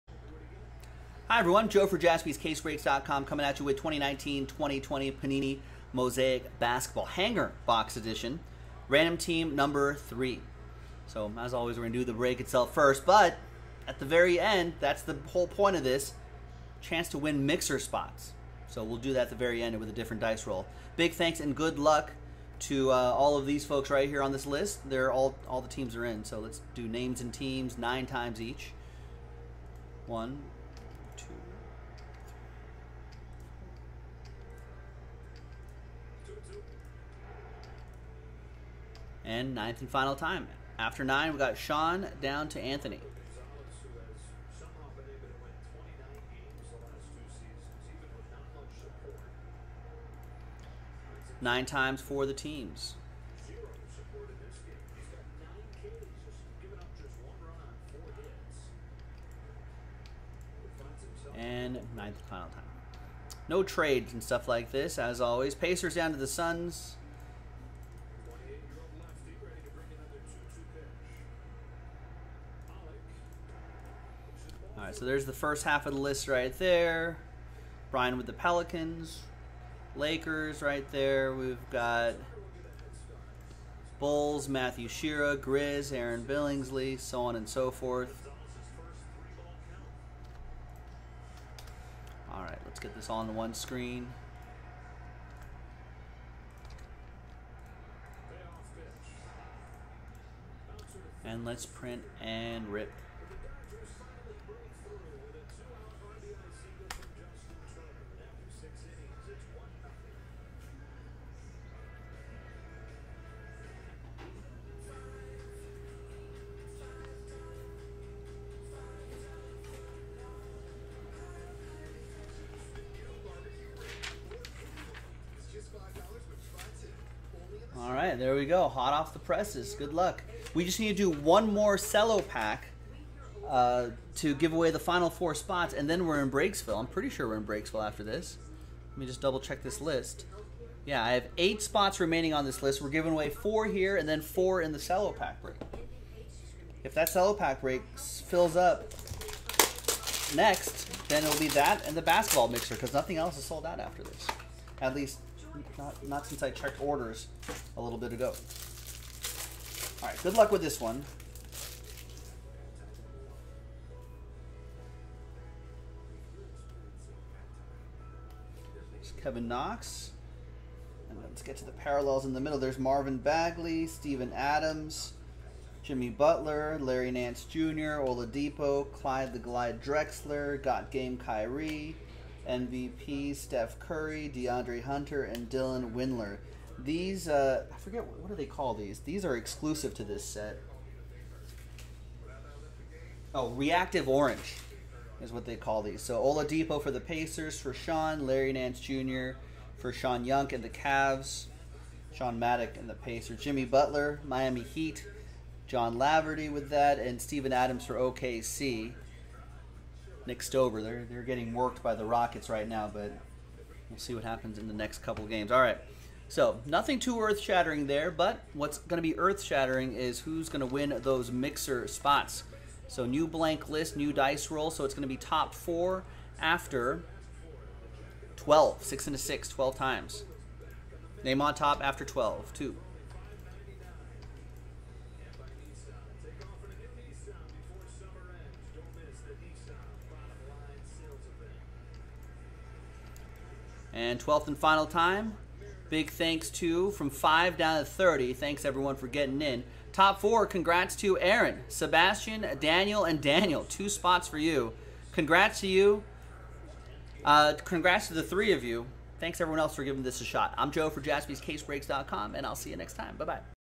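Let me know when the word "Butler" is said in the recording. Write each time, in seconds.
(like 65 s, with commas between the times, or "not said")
176 s, 203 s.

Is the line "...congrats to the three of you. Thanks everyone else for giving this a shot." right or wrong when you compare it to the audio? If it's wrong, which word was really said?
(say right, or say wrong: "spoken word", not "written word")
right.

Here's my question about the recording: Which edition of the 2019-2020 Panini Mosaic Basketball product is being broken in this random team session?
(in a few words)
Hanger Box Edition.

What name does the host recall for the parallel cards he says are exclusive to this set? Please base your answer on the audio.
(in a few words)
Reactive Orange.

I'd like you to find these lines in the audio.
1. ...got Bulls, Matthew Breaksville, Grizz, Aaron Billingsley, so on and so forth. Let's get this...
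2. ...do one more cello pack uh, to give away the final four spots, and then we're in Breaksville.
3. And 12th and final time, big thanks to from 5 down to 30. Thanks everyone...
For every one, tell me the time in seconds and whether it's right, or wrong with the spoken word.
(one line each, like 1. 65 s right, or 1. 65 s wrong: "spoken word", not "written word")
1. 81 s wrong: "Shira", not "Breaksville"
2. 130 s right
3. 243 s right.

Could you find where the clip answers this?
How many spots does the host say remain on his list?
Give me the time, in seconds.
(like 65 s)
141 s.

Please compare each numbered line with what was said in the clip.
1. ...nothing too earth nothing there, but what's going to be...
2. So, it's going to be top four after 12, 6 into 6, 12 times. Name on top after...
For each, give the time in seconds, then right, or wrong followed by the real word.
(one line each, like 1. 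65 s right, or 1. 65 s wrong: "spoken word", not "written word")
1. 216 s wrong: "shattering", not "nothing"
2. 224 s right.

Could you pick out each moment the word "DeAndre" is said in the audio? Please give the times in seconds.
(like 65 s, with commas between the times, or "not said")
184 s.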